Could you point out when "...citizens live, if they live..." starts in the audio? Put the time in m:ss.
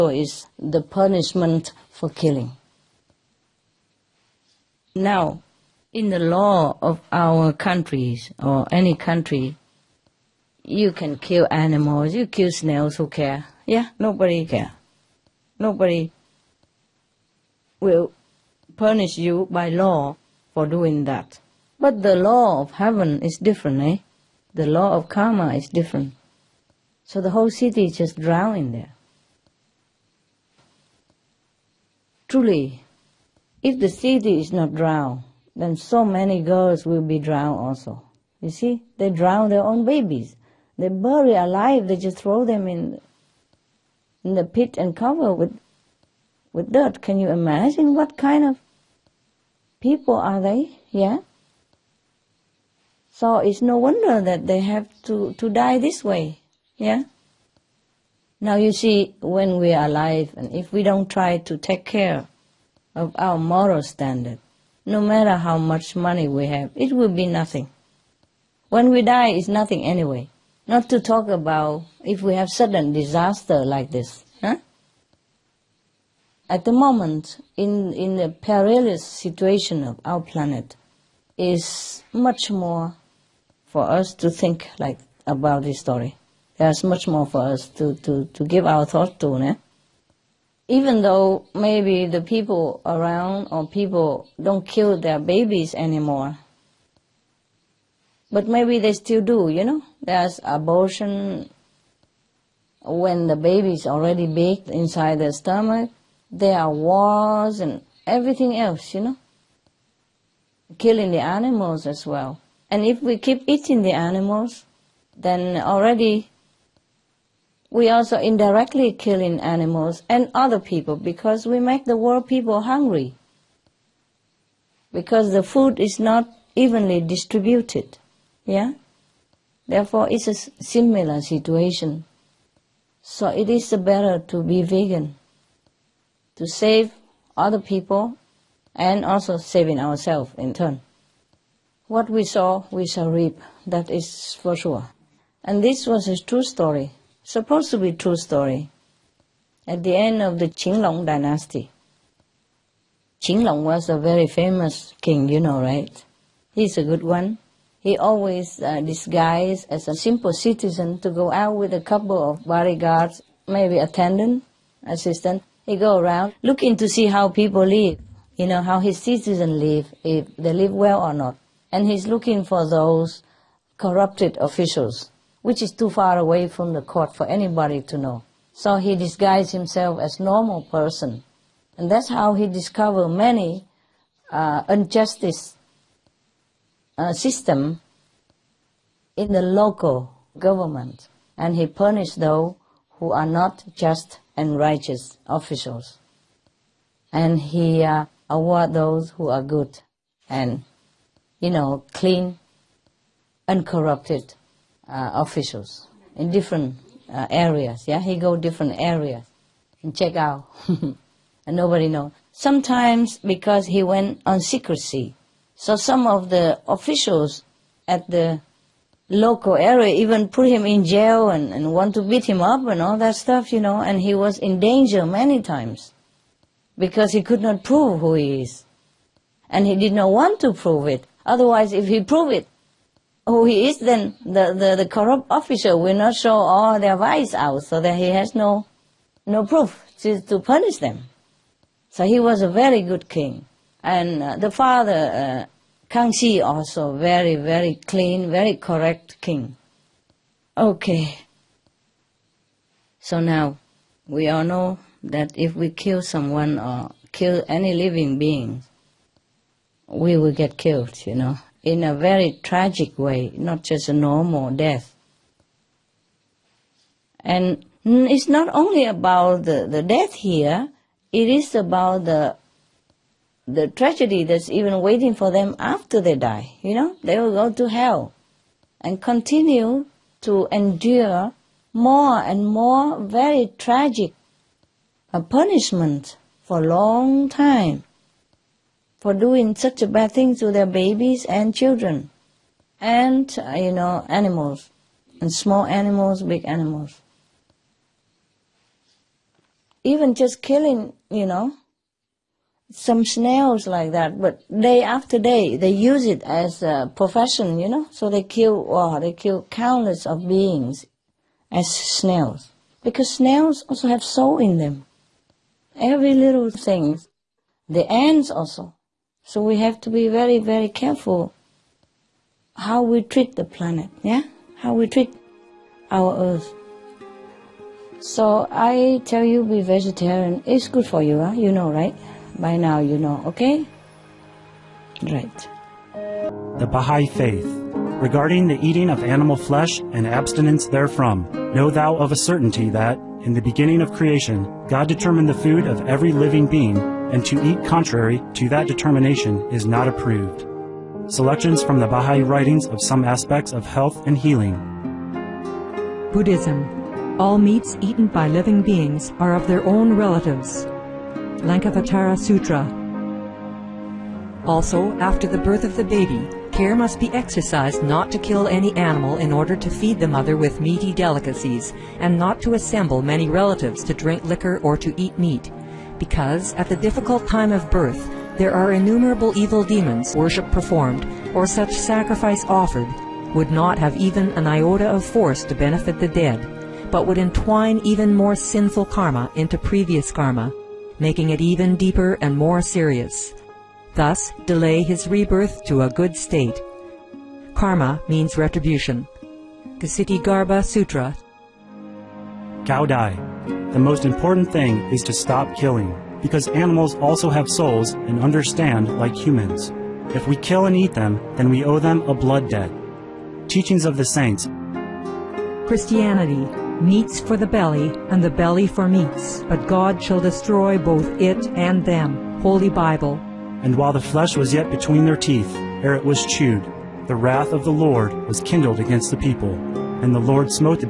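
2:49.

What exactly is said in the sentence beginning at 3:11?
And he punished those who are not just and righteous officials.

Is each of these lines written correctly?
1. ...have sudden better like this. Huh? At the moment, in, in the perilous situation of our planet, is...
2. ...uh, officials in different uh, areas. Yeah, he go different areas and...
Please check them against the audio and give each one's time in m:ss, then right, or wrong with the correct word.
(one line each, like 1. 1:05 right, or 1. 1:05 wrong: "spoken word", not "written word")
1. 1:12 wrong: "disaster", not "better"
2. 3:24 right.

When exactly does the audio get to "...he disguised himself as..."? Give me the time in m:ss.
2:58.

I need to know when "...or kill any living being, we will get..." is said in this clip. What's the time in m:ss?
4:16.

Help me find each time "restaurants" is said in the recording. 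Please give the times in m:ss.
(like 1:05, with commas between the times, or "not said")
not said.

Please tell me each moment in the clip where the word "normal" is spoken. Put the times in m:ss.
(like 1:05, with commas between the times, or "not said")
3:00, 4:23.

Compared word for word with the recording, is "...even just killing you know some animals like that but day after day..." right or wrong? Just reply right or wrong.
wrong.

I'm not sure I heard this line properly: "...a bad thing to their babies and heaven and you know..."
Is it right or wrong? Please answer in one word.
wrong.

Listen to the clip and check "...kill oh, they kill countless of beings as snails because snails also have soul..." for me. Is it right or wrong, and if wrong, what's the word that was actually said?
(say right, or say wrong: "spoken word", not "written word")
right.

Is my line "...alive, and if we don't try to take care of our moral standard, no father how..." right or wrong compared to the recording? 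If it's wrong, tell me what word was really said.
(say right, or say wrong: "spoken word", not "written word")
wrong: "matter", not "father".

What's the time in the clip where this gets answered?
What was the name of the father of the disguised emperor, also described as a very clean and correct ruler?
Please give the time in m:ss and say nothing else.
4:05.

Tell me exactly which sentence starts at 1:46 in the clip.
There are wars and everything else, you know?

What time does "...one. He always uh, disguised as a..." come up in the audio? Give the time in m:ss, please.
2:37.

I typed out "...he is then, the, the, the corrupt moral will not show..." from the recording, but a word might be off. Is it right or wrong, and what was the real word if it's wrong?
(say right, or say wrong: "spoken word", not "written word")
wrong: "official", not "moral".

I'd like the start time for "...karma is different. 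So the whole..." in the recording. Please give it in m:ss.
0:25.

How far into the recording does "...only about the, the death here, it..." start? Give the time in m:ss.
4:28.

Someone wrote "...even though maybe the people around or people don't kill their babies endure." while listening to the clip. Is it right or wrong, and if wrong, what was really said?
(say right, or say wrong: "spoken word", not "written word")
wrong: "anymore", not "endure".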